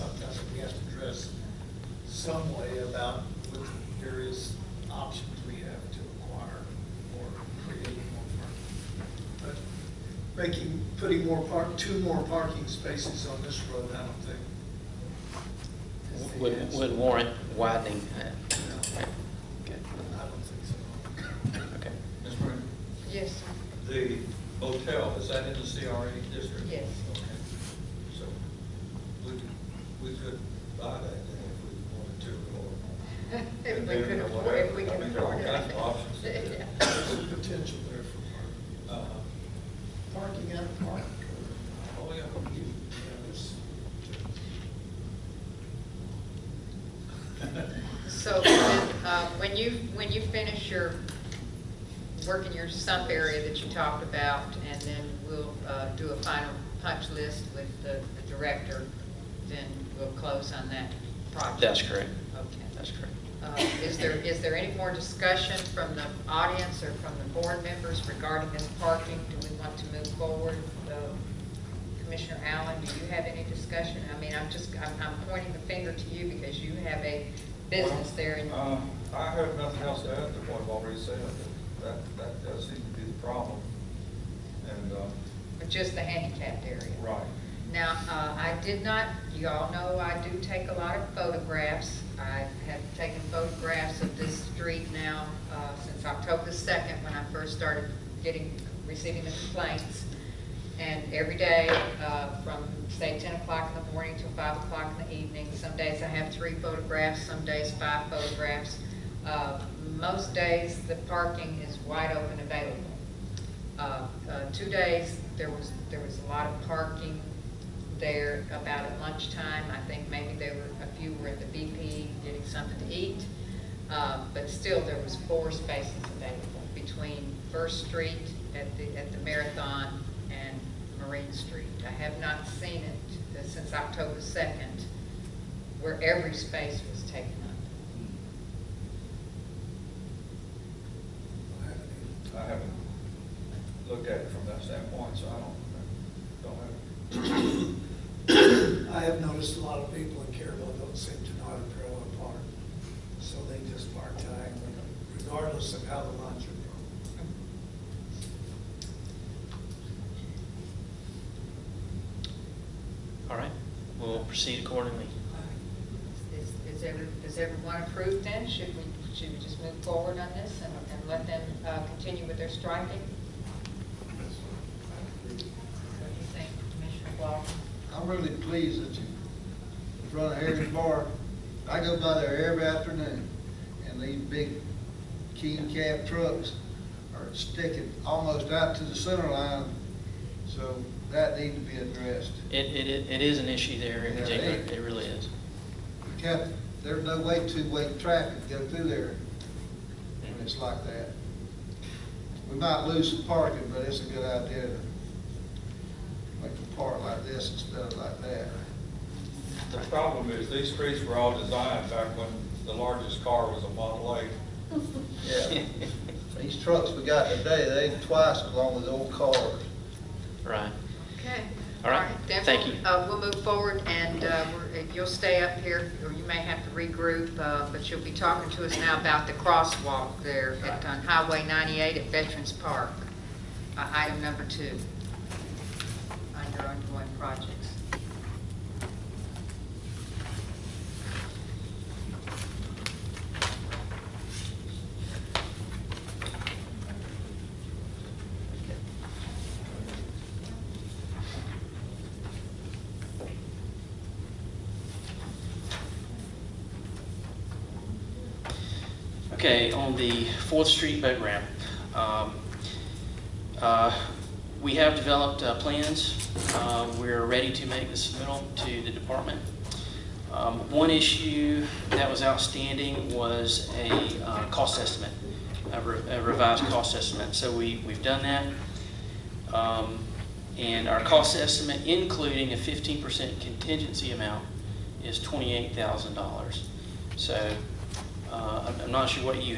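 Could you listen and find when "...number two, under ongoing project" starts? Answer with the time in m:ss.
3:54.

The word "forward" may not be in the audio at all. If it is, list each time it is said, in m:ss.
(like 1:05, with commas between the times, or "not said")
1:10, 2:49, 3:43.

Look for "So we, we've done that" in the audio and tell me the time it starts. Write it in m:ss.
4:37.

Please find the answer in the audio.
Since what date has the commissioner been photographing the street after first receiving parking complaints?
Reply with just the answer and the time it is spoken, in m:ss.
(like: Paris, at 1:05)
October 2nd, at 1:36.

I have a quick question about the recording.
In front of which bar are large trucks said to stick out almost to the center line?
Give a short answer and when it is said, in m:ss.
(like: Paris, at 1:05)
Harry's Bar, at 3:00.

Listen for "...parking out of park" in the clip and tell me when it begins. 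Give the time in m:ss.
0:40.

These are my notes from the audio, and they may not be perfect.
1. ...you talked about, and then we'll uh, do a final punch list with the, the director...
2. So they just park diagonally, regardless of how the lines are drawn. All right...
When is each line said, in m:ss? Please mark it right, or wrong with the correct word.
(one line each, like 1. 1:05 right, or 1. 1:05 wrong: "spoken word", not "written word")
1. 0:53 right
2. 2:33 right.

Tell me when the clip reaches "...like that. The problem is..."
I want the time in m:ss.
3:27.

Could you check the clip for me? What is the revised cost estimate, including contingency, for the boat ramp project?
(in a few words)
$28,000.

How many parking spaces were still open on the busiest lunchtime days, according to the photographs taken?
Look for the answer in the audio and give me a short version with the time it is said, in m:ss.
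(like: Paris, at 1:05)
4, at 2:05.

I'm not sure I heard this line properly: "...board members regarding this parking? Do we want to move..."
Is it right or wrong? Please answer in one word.
right.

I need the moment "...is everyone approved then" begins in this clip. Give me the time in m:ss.
2:47.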